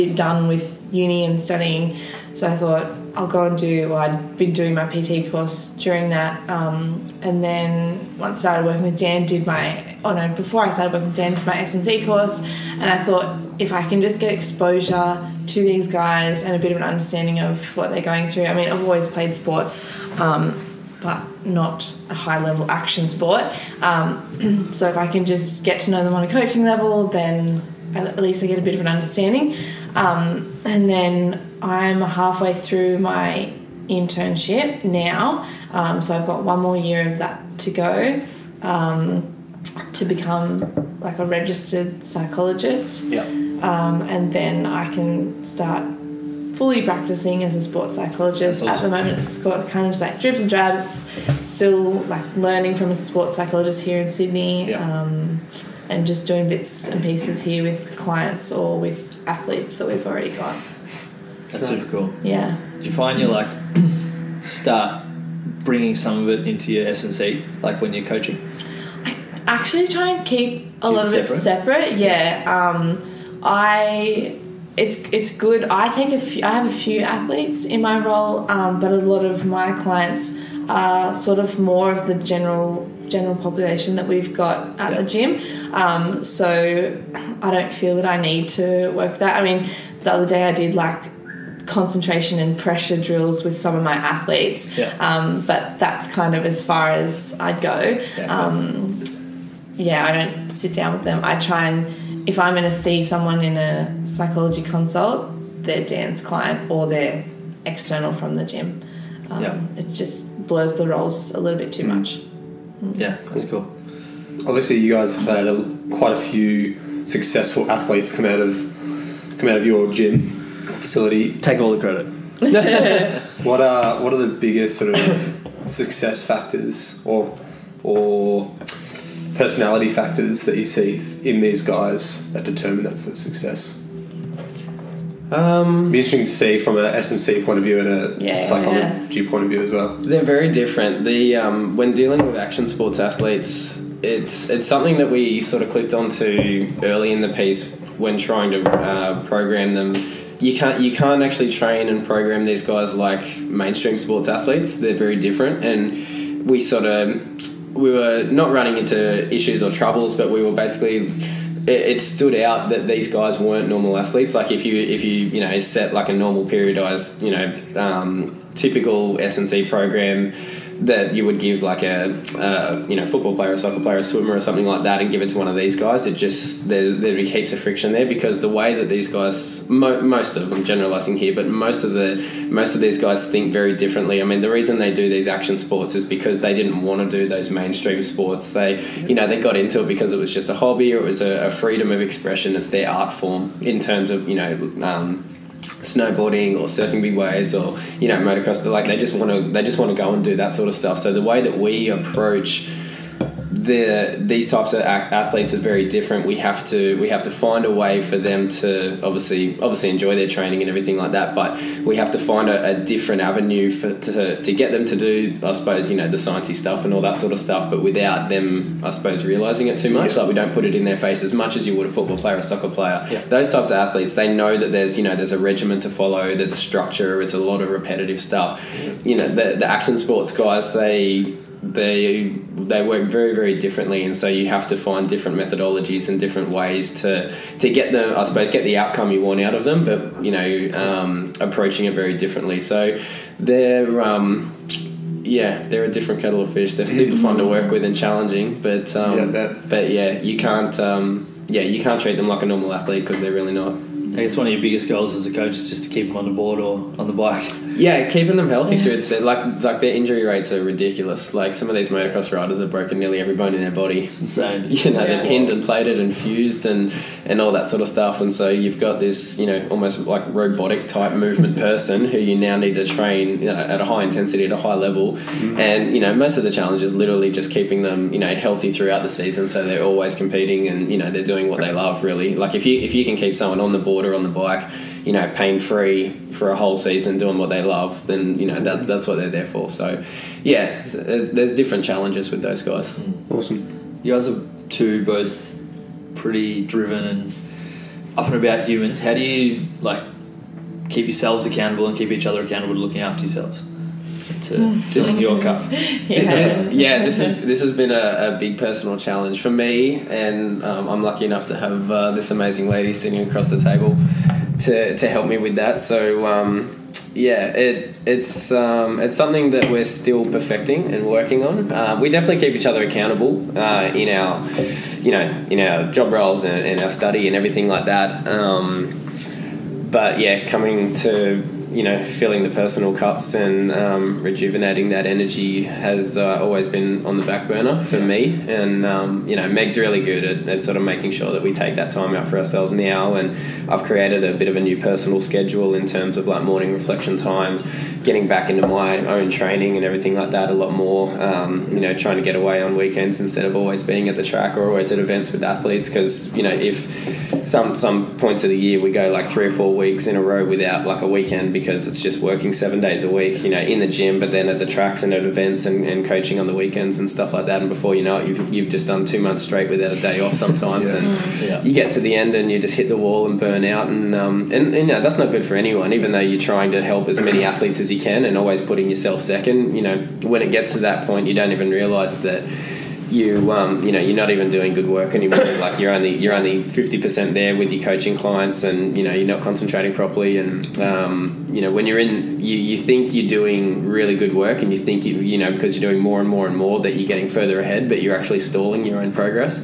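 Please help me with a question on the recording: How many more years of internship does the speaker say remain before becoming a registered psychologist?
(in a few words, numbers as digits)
1.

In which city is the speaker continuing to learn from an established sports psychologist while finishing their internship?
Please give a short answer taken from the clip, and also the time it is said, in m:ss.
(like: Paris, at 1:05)
Sydney, at 0:54.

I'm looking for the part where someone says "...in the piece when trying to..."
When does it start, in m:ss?
2:27.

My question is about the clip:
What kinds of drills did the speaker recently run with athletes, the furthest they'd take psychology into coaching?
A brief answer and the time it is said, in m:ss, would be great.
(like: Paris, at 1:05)
Concentration and pressure drills, at 1:31.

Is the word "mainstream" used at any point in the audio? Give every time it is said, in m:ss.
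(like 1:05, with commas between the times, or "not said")
2:33, 3:07.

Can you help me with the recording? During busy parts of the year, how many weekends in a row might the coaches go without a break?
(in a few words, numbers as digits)
3 or 4.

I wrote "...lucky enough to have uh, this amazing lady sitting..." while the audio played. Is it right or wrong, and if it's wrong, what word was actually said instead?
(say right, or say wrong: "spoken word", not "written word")
right.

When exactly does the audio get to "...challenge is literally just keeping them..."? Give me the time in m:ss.
4:36.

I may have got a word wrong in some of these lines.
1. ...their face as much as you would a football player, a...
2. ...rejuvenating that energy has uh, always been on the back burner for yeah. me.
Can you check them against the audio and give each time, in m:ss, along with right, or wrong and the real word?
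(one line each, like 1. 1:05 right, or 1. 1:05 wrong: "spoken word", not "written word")
1. 3:40 right
2. 5:34 right.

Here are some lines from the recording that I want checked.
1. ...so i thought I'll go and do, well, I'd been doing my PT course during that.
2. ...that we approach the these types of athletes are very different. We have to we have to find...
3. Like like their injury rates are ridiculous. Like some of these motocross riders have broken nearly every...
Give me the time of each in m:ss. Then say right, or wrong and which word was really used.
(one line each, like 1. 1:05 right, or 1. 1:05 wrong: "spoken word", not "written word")
1. 0:02 right
2. 3:21 right
3. 4:19 right.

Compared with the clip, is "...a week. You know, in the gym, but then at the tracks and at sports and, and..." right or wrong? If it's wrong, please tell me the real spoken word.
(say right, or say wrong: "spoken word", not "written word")
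wrong: "events", not "sports".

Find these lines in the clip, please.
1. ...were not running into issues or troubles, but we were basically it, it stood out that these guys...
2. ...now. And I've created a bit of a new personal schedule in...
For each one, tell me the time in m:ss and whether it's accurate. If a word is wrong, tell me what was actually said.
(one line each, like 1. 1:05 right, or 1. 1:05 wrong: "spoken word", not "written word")
1. 2:37 right
2. 5:42 right.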